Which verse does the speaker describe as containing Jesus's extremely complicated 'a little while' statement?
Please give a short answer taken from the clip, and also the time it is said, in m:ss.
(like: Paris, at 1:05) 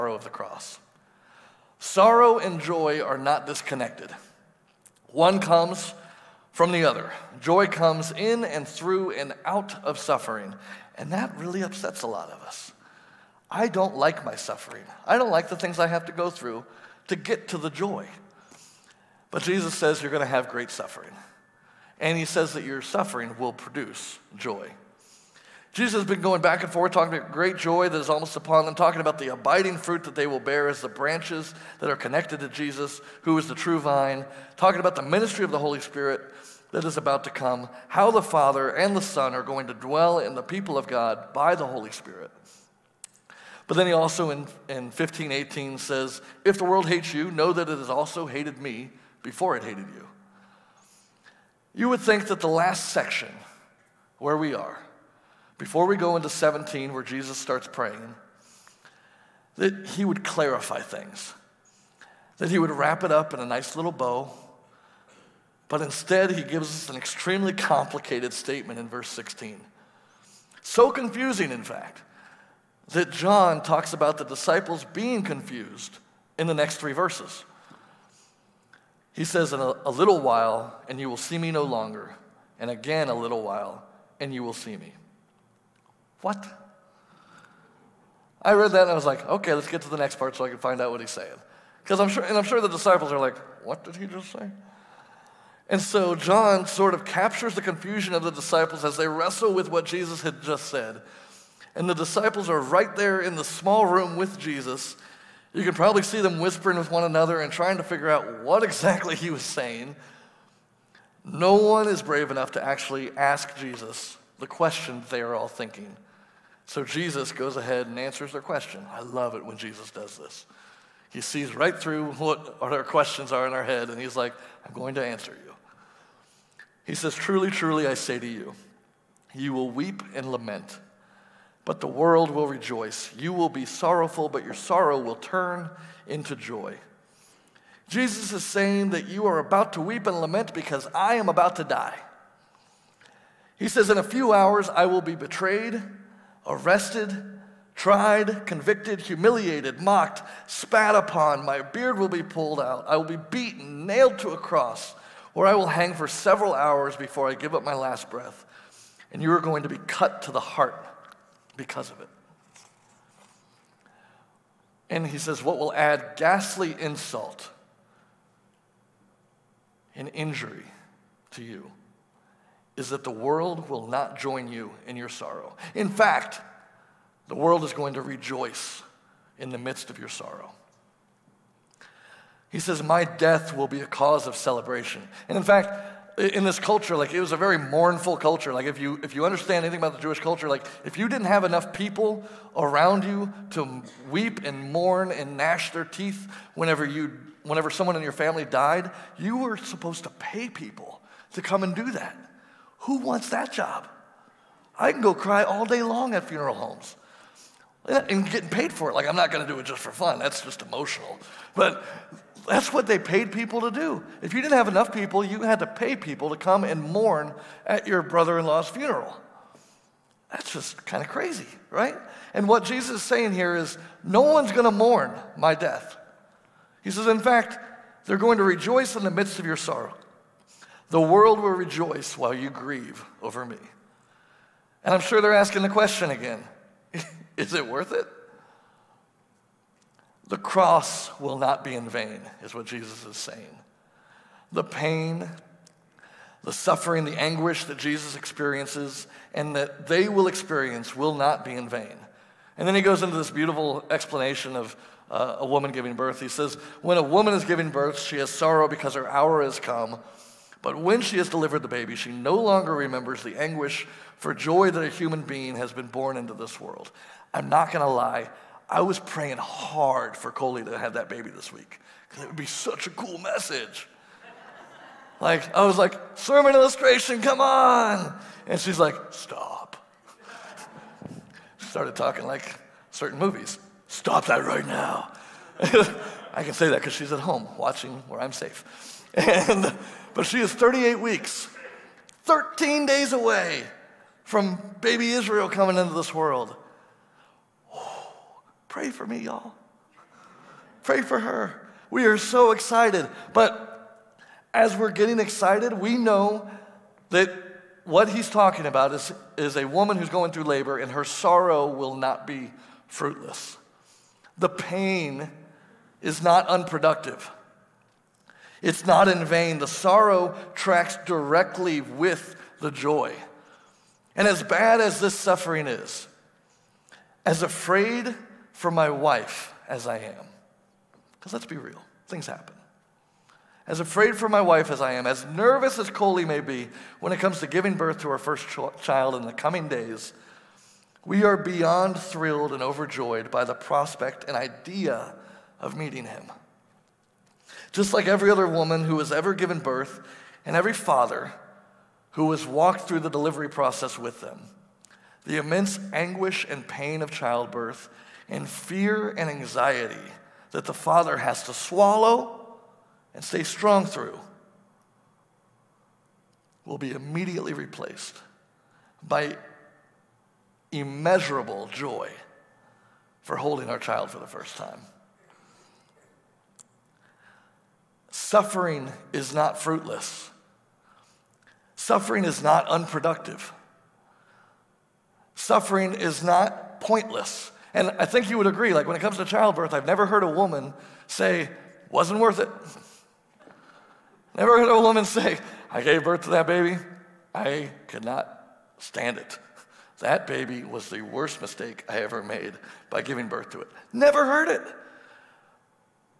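Verse 16, at 1:08.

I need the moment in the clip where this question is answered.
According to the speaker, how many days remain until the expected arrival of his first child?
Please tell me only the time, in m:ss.
4:52.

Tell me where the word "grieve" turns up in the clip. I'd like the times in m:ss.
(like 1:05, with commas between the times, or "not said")
3:52.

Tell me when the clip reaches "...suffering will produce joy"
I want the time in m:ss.
0:22.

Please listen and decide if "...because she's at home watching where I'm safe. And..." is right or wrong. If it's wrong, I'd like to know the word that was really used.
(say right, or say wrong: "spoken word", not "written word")
right.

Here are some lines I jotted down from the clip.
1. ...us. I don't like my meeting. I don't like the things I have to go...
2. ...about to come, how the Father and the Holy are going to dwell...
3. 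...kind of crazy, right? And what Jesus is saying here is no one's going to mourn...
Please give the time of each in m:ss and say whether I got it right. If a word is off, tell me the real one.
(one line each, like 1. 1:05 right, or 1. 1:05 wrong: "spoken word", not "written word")
1. 0:12 wrong: "suffering", not "meeting"
2. 0:36 wrong: "Son", not "Holy"
3. 3:40 right.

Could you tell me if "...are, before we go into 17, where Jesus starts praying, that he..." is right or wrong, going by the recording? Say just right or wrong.
right.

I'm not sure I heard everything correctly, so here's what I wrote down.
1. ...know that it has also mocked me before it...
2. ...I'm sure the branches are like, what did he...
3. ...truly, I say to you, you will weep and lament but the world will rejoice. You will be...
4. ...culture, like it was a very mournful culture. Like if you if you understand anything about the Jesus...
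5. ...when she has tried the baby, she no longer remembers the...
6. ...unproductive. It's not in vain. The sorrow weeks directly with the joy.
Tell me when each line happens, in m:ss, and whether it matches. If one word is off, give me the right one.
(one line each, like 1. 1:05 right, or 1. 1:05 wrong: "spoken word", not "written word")
1. 0:47 wrong: "hated", not "mocked"
2. 1:32 wrong: "disciples", not "branches"
3. 2:07 right
4. 3:06 wrong: "Jewish", not "Jesus"
5. 4:20 wrong: "delivered", not "tried"
6. 5:16 wrong: "tracks", not "weeks".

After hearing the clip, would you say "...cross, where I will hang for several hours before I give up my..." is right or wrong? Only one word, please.
right.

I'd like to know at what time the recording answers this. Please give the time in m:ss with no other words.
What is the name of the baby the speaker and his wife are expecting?
4:54.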